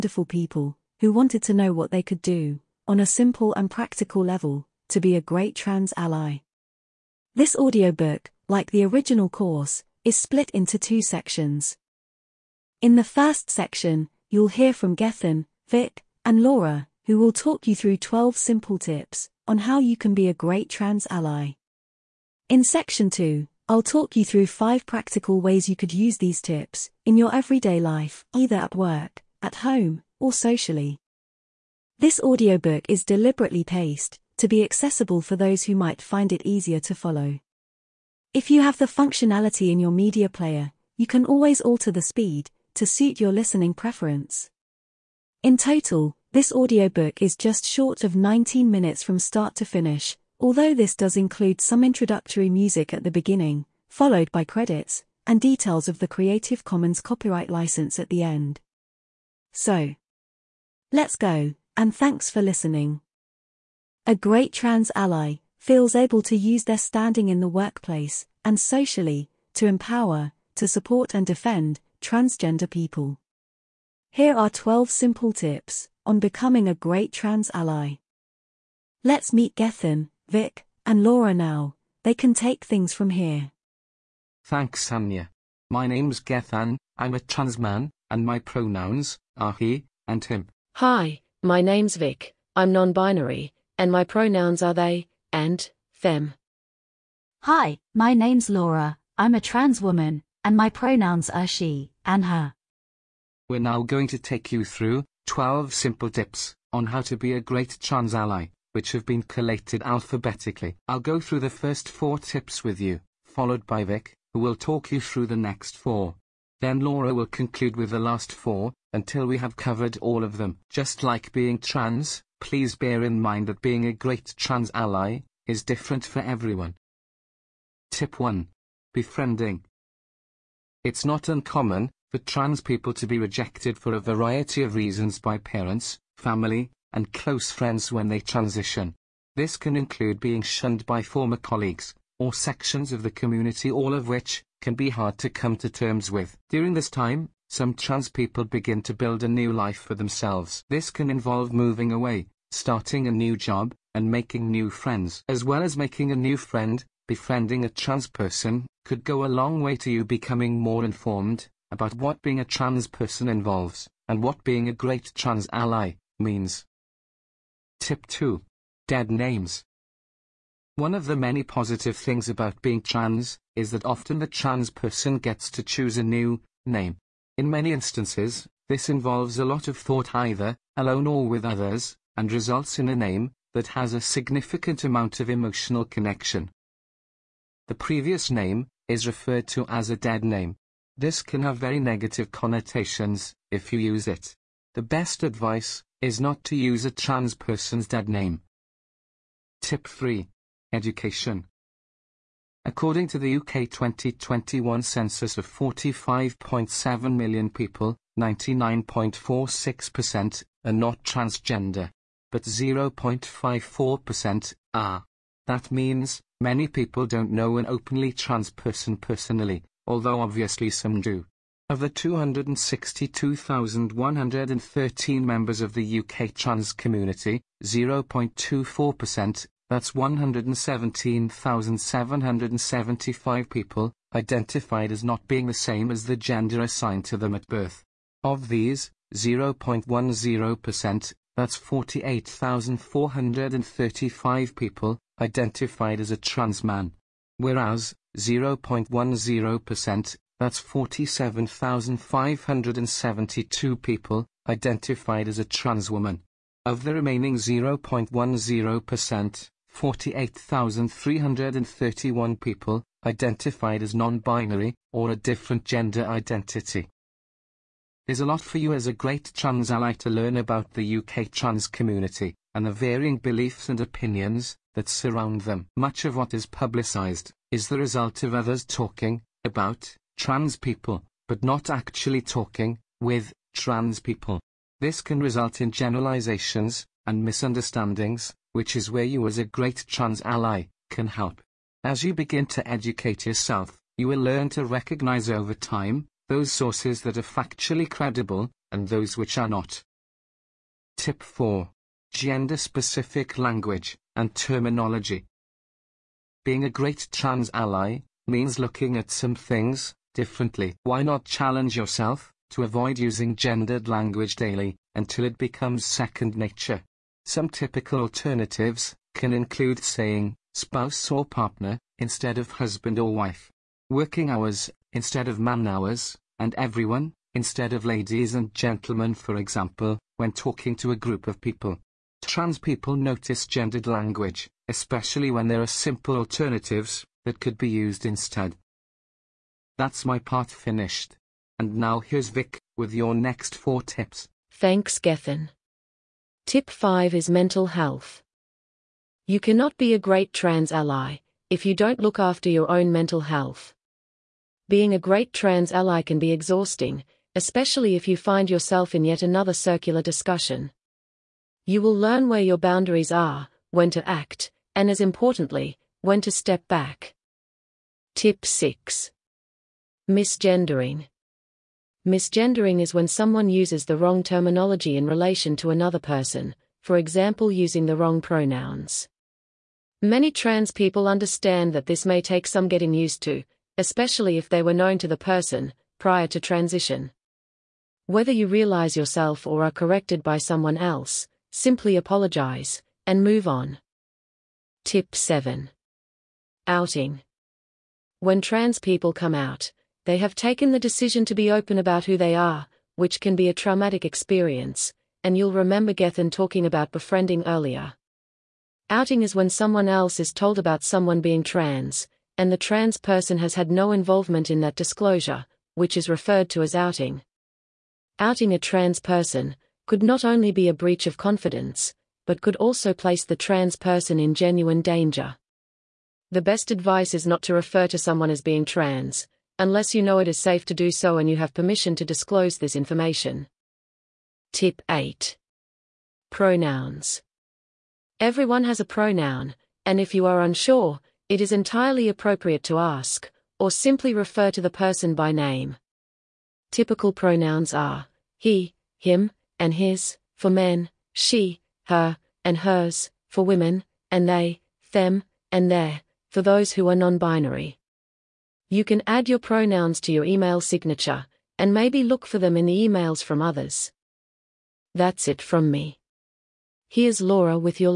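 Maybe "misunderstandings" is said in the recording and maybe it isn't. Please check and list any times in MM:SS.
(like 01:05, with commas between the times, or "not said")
04:47.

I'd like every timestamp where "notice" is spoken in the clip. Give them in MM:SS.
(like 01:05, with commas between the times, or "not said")
05:32.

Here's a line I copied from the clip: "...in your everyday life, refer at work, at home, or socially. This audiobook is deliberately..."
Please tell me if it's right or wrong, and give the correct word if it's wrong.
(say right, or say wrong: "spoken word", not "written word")
wrong: "either", not "refer".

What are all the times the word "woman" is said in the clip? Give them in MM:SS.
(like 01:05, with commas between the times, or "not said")
01:39, 04:15.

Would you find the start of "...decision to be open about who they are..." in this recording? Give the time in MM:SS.
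06:40.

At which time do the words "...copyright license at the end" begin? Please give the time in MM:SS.
00:56.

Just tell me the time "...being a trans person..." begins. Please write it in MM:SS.
02:42.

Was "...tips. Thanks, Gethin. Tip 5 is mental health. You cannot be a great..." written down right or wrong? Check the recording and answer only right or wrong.
right.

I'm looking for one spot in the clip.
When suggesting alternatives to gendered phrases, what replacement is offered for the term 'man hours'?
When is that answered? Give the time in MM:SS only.
05:23.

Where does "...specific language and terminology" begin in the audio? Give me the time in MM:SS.
05:02.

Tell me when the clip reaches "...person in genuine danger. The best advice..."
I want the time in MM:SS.
07:03.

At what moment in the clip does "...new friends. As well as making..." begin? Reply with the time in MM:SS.
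02:34.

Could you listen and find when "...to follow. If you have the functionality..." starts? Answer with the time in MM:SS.
00:36.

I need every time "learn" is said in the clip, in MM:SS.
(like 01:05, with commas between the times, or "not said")
04:30, 04:54, 06:01.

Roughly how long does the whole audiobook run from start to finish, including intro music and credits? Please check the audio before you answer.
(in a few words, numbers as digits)
just short of 19 minutes.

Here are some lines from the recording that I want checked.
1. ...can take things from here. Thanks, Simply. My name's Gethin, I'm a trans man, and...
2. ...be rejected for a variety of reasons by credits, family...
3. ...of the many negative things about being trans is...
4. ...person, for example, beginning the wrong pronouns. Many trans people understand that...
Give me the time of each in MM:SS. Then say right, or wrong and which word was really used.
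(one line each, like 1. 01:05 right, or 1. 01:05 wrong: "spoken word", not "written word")
1. 01:22 wrong: "Anja", not "Simply"
2. 02:13 wrong: "parents", not "credits"
3. 02:50 wrong: "positive", not "negative"
4. 06:15 wrong: "using", not "beginning".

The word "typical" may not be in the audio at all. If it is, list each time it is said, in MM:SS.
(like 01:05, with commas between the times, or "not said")
05:17, 07:26.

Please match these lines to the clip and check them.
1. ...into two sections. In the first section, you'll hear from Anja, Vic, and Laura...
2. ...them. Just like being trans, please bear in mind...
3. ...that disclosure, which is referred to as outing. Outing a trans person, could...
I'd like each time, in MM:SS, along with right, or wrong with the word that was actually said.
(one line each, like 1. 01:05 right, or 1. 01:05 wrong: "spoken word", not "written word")
1. 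00:10 wrong: "Gethin", not "Anja"
2. 02:00 right
3. 06:54 right.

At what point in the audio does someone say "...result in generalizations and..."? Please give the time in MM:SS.
04:45.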